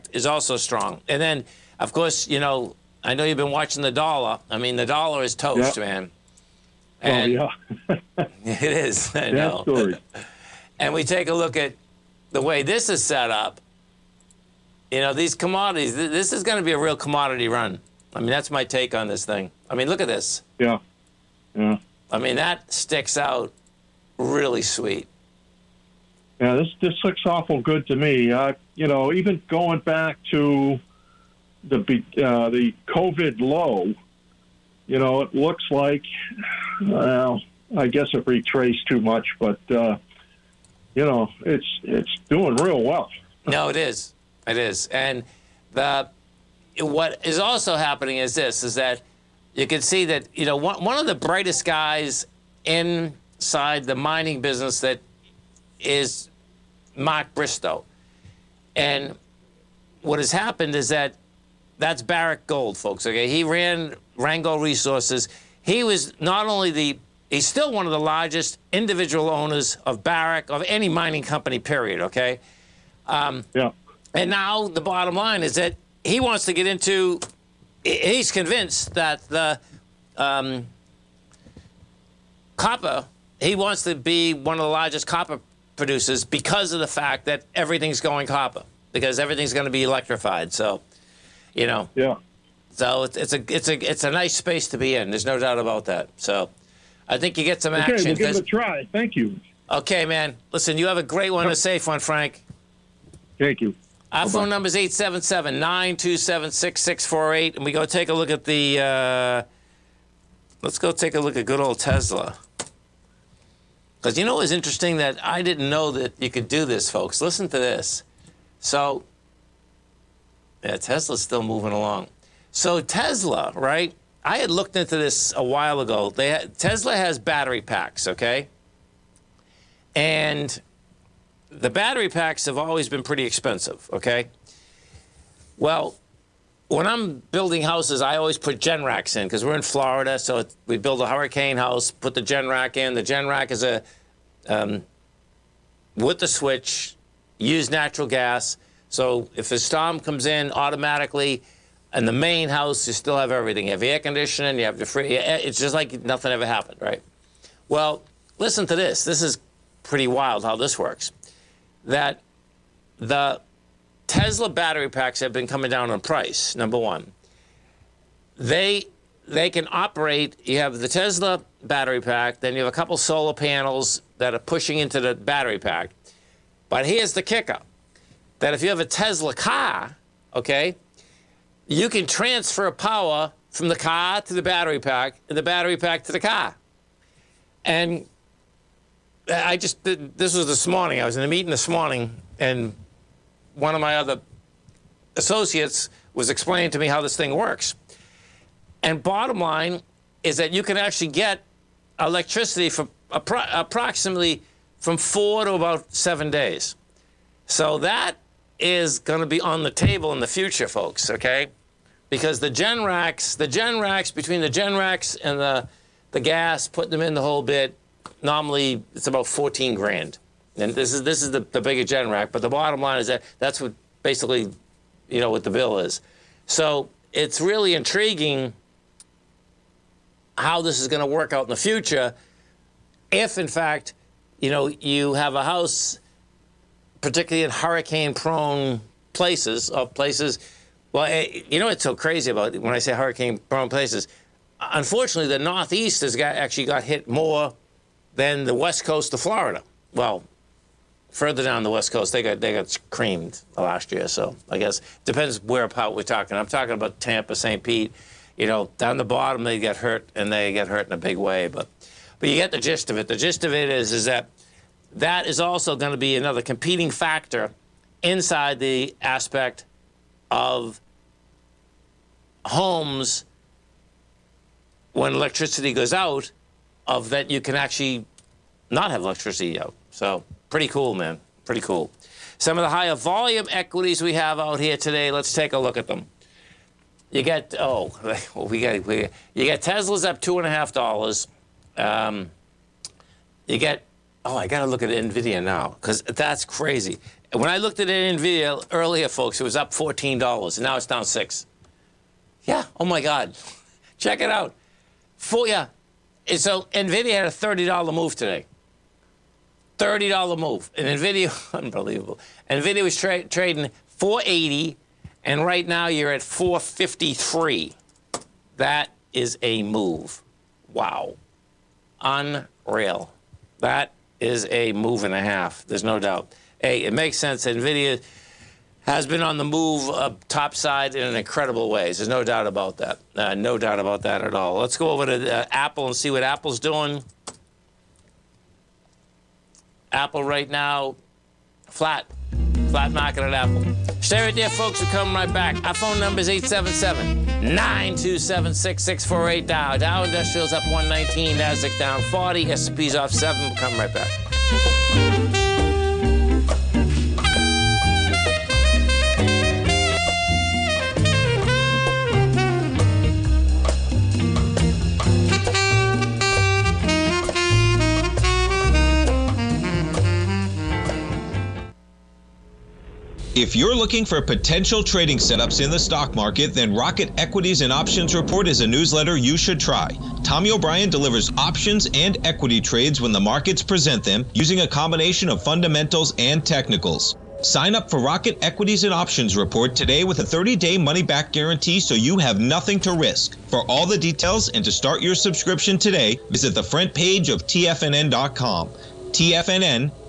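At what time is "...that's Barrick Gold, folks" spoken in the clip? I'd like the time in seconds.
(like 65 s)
61 s.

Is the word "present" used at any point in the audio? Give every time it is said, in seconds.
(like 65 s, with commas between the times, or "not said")
383 s.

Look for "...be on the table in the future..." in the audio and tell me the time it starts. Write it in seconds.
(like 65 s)
209 s.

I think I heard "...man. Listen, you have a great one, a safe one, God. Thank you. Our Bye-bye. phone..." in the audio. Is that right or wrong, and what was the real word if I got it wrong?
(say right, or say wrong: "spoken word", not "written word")
wrong: "Frank", not "God".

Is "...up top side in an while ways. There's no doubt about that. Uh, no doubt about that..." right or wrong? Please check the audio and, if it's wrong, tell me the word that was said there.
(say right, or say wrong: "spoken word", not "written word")
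wrong: "incredible", not "while".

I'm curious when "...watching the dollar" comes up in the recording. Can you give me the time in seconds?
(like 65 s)
3 s.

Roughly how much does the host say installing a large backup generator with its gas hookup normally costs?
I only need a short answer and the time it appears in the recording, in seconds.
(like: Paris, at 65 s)
14 grand, at 219 s.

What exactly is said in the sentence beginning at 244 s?
Unfortunately, the Northeast has got, actually got hit more than the West Coast of Florida.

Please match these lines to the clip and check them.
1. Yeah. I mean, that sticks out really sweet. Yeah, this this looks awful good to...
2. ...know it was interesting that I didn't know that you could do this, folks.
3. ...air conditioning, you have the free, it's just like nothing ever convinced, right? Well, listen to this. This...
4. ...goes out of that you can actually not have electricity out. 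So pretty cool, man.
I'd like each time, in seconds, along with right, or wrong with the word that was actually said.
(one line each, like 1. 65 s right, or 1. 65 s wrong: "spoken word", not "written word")
1. 21 s right
2. 114 s right
3. 153 s wrong: "happened", not "convinced"
4. 275 s right.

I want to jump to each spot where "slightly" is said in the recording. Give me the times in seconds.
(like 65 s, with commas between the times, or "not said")
not said.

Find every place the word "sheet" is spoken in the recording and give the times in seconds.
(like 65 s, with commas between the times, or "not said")
not said.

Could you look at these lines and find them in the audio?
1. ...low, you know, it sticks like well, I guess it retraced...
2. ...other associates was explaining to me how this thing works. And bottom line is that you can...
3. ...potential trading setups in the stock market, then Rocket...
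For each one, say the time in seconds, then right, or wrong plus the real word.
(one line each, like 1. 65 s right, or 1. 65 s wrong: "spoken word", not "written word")
1. 33 s wrong: "looks", not "sticks"
2. 193 s right
3. 374 s right.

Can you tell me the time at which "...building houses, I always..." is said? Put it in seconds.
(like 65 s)
137 s.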